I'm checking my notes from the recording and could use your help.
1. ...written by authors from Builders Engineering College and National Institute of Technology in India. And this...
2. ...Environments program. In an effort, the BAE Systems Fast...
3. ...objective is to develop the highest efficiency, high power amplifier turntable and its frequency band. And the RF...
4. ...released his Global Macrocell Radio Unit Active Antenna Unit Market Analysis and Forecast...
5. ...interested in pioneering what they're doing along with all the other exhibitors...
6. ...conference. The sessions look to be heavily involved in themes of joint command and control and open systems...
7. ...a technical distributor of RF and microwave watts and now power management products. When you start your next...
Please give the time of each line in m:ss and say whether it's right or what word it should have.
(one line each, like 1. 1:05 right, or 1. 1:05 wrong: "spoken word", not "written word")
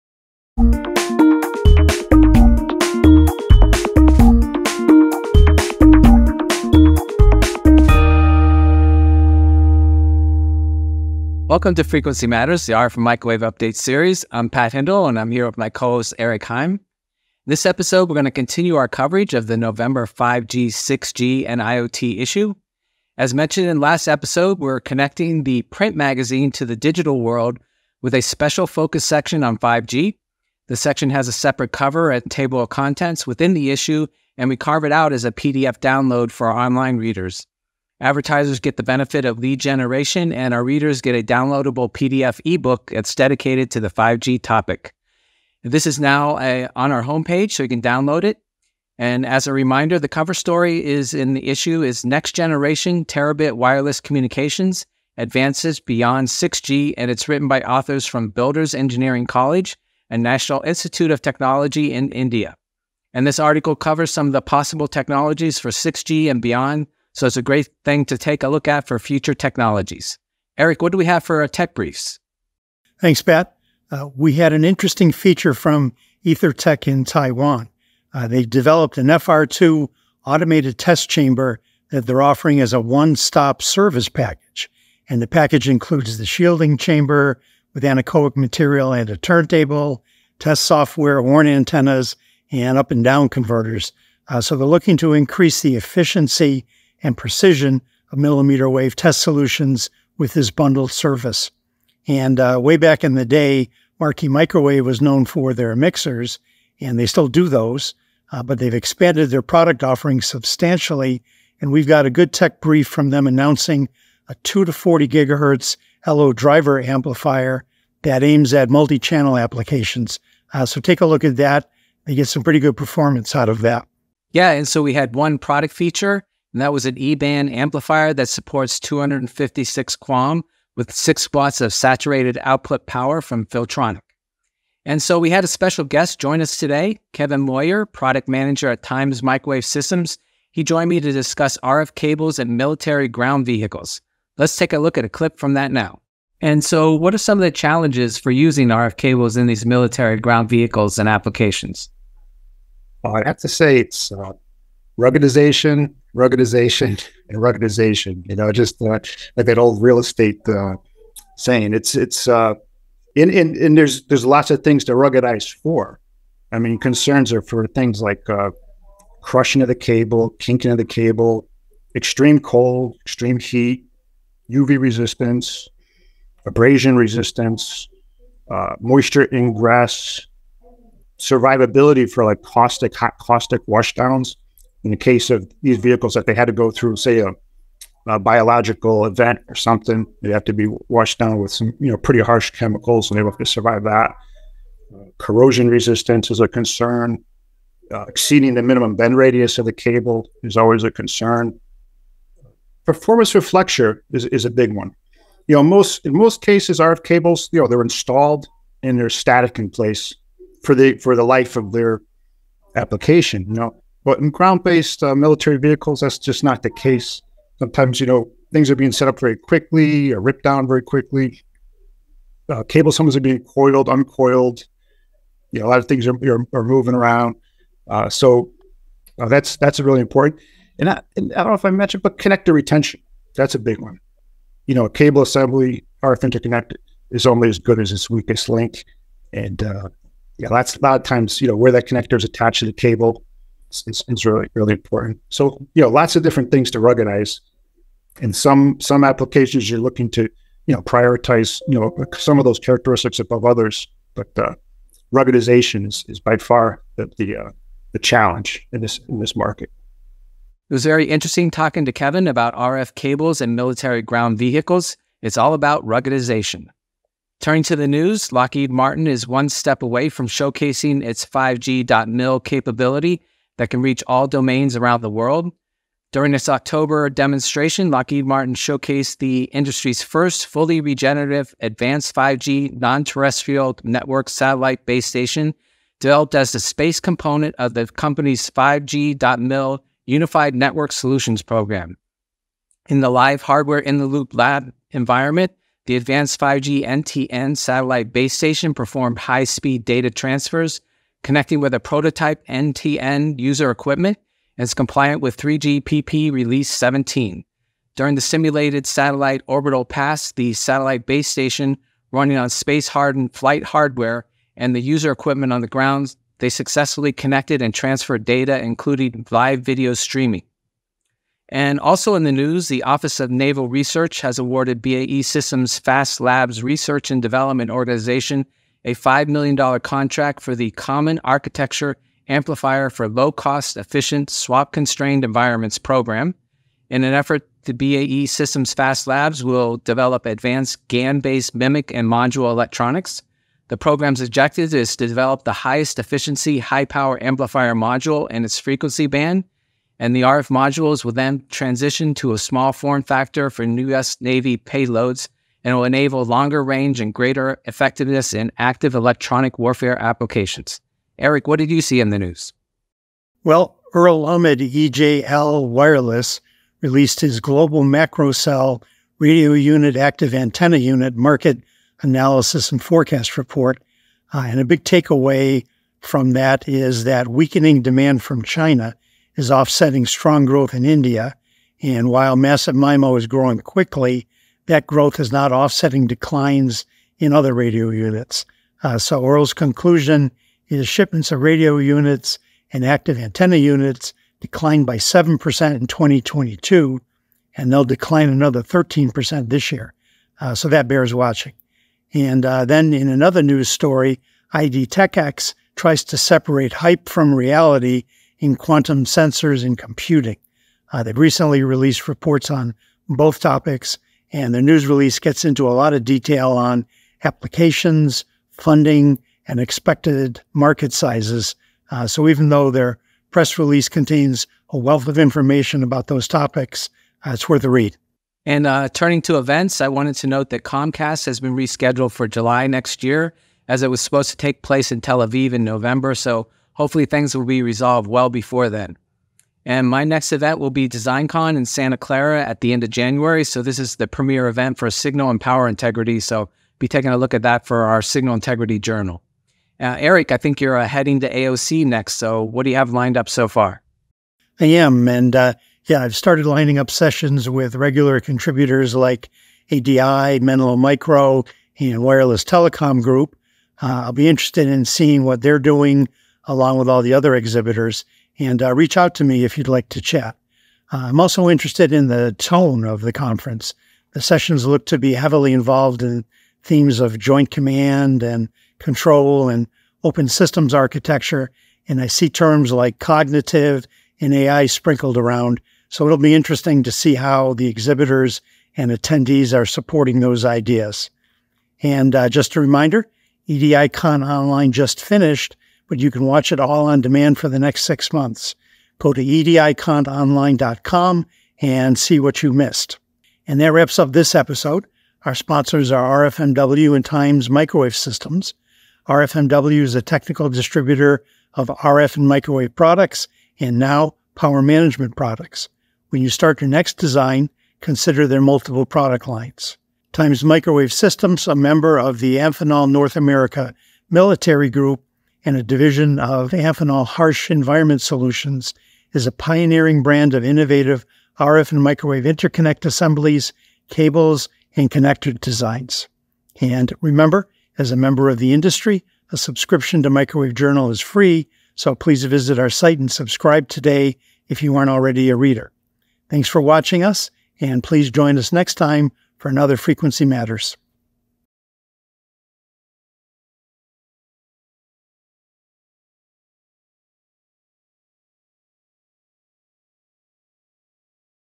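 1. 0:57 right
2. 5:35 right
3. 5:44 wrong: "module", not "turntable"
4. 6:06 right
5. 7:44 wrong: "seeing", not "pioneering"
6. 7:53 right
7. 8:29 wrong: "products", not "watts".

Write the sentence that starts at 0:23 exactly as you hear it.
As mentioned in last episode, we're connecting the print magazine to the digital world with a special focus section on 5G.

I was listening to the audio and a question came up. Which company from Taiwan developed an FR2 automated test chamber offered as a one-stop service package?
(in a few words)
EtherTech.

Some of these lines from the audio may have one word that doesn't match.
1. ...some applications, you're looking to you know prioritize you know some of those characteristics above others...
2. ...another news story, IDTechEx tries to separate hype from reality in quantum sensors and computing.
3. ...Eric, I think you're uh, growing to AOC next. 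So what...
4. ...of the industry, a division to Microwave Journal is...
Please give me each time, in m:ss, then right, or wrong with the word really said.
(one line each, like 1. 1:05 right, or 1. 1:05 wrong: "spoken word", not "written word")
1. 4:08 right
2. 6:43 right
3. 7:29 wrong: "heading", not "growing"
4. 8:58 wrong: "subscription", not "division".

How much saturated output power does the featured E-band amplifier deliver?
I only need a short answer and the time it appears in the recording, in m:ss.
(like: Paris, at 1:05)
6 watts, at 2:10.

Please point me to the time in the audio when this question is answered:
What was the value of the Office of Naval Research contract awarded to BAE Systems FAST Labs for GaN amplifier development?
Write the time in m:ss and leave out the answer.
5:28.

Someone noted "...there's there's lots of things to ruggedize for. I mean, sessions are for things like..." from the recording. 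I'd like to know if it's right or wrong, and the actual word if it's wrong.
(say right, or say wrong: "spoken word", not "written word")
wrong: "concerns", not "sessions".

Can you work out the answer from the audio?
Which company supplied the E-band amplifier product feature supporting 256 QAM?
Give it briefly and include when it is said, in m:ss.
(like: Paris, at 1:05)
Filtronic, at 2:13.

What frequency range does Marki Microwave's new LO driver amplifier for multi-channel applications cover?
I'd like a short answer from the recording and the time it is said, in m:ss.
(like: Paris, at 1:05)
2 to 40 GHz, at 1:54.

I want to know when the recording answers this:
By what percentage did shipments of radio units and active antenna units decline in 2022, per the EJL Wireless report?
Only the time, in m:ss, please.
6:34.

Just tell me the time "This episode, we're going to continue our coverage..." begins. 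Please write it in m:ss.
0:17.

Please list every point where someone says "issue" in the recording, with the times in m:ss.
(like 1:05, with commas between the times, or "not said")
0:22, 0:33, 0:51.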